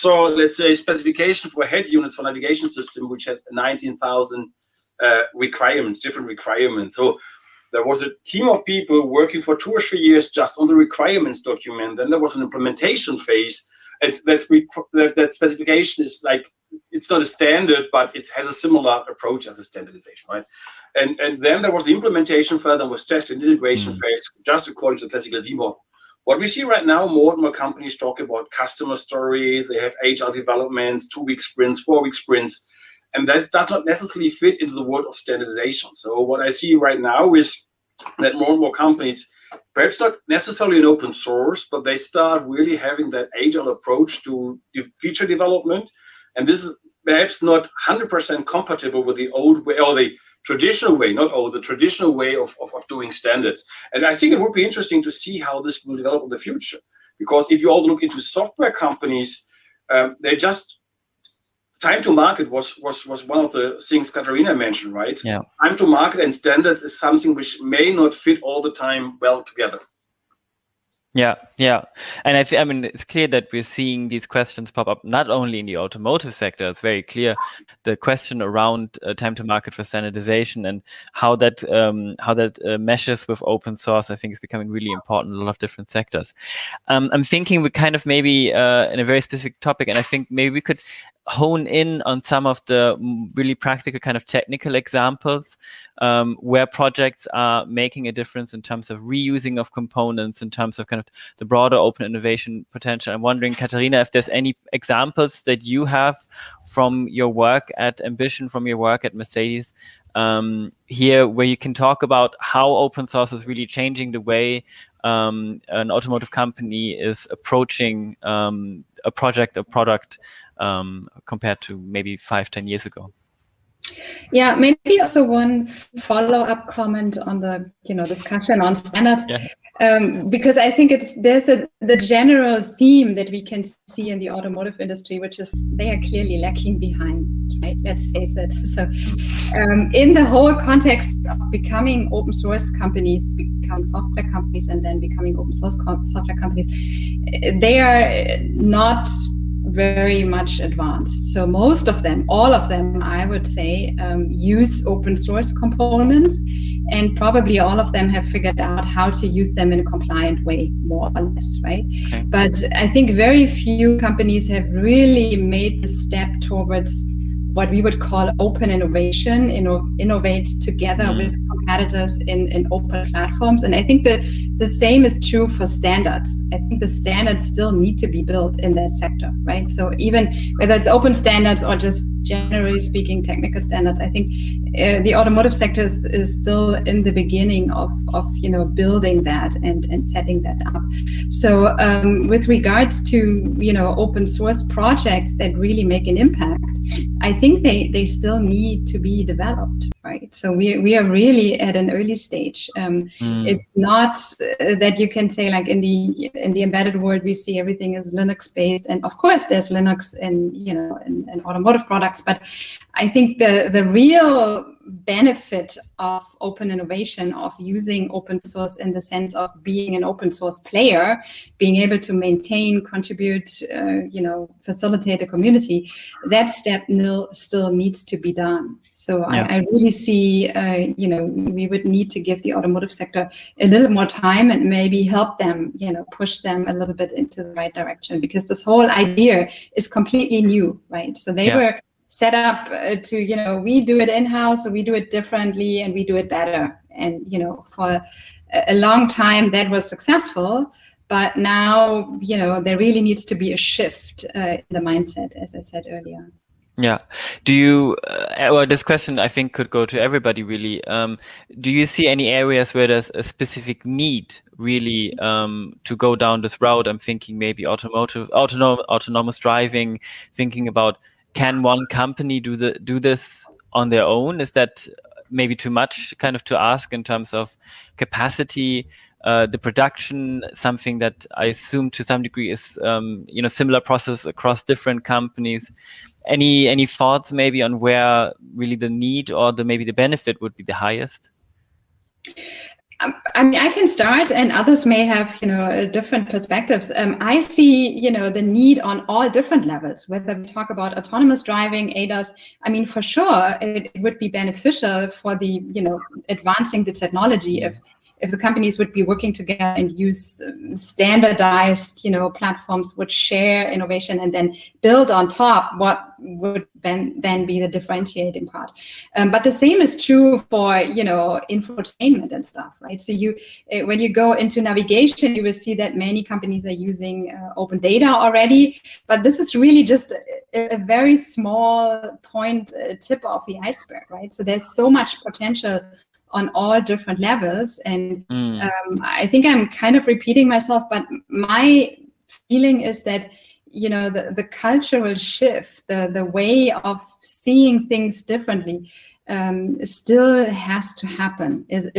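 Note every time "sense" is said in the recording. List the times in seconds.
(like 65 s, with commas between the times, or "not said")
218 s.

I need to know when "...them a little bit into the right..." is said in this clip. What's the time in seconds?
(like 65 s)
236 s.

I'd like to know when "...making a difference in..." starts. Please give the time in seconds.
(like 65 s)
97 s.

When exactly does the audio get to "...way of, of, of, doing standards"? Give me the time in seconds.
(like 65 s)
52 s.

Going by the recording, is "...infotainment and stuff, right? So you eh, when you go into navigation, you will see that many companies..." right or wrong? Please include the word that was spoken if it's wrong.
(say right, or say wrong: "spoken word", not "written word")
right.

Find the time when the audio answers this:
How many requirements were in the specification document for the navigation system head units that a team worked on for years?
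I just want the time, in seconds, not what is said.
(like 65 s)
3 s.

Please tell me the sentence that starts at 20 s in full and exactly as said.
And and then there was the implementation phase, there was test and integration mm phase, just according to the classical V model.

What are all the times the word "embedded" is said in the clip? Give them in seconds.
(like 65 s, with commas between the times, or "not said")
206 s.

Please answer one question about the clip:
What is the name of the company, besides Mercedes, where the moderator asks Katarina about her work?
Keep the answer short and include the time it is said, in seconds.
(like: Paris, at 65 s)
MBition, at 107 s.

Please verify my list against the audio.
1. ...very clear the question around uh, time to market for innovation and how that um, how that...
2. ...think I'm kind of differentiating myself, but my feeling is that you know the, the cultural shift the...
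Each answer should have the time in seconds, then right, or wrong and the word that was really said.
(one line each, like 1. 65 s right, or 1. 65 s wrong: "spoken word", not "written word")
1. 76 s wrong: "standardization", not "innovation"
2. 339 s wrong: "repeating", not "differentiating".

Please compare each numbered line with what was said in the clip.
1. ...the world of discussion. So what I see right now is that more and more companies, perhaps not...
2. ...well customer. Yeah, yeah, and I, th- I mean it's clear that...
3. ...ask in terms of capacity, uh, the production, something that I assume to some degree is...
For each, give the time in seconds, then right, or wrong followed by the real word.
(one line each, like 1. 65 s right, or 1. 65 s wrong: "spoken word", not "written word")
1. 34 s wrong: "standardization", not "discussion"
2. 69 s wrong: "together", not "customer"
3. 276 s right.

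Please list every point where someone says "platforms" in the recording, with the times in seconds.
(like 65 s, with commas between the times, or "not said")
173 s, 312 s.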